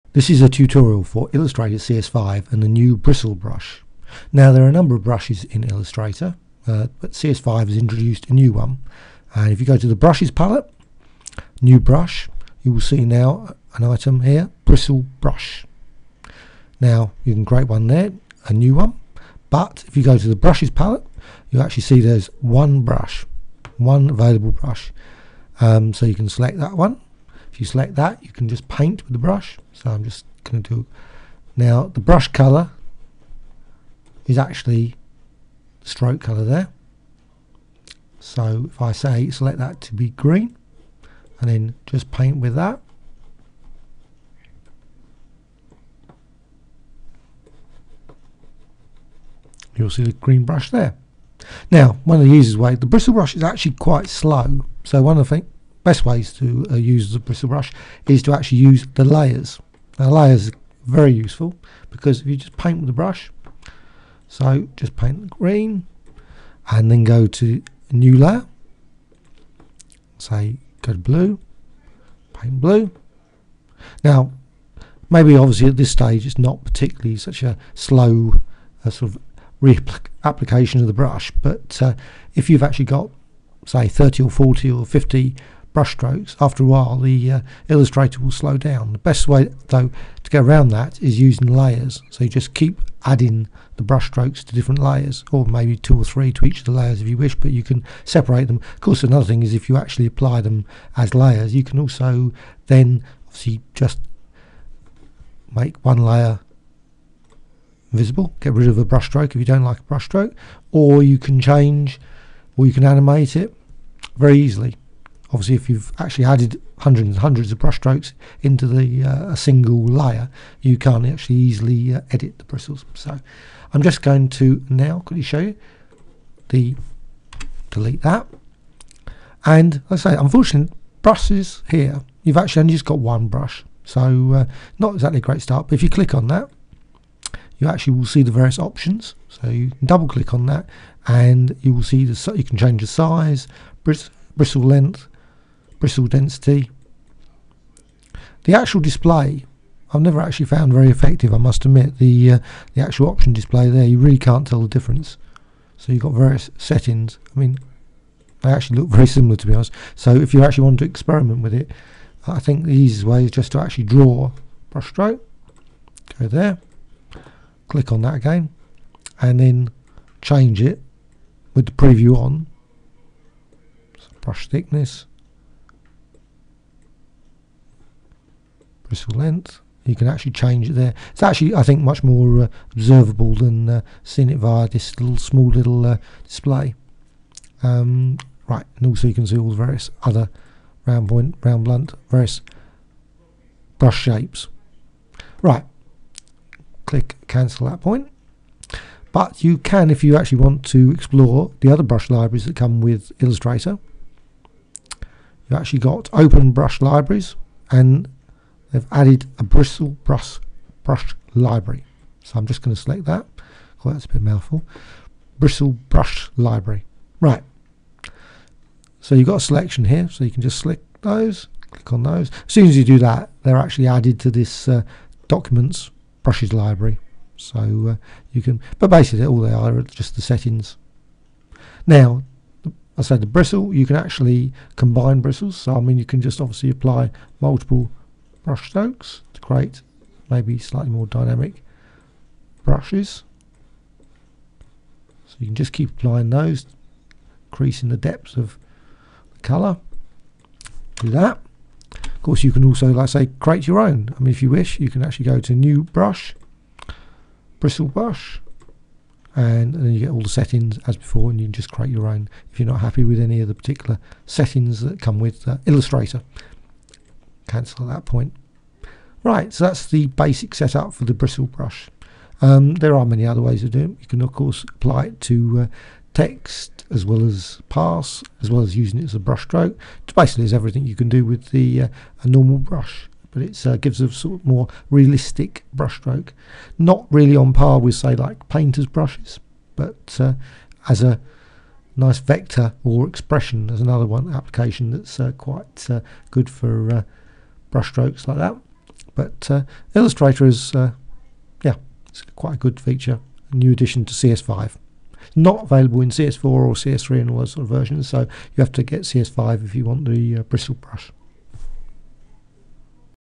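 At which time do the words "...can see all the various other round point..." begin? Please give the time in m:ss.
3:09.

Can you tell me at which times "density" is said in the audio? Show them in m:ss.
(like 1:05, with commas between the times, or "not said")
2:26.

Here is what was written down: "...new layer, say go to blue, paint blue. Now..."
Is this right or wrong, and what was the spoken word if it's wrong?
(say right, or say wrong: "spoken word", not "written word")
right.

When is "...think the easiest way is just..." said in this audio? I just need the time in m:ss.
2:42.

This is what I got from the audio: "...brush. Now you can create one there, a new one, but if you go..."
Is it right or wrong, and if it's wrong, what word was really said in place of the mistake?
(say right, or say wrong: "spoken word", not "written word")
right.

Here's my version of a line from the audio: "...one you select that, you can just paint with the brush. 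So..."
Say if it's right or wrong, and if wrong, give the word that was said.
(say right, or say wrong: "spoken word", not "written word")
right.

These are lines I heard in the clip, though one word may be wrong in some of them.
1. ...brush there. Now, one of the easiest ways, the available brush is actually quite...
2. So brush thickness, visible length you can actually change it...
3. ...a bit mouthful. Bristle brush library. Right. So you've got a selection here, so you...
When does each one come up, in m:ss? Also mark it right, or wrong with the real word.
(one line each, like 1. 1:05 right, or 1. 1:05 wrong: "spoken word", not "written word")
1. 0:50 wrong: "bristle", not "available"
2. 2:53 wrong: "bristle", not "visible"
3. 3:34 right.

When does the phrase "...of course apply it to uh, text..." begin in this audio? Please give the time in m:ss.
4:34.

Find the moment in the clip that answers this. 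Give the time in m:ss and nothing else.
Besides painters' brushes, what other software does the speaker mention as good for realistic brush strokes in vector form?
4:53.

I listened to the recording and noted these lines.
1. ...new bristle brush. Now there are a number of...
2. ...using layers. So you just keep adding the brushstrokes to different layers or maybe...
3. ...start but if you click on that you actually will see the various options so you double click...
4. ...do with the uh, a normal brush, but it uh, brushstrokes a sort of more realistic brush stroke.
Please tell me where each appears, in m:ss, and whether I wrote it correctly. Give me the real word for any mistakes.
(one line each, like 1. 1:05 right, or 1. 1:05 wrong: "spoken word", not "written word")
1. 0:02 right
2. 1:31 right
3. 2:15 right
4. 4:41 wrong: "gives", not "brushstrokes".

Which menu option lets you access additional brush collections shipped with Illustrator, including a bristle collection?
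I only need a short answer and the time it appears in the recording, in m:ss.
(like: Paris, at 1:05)
Open brush libraries, at 3:26.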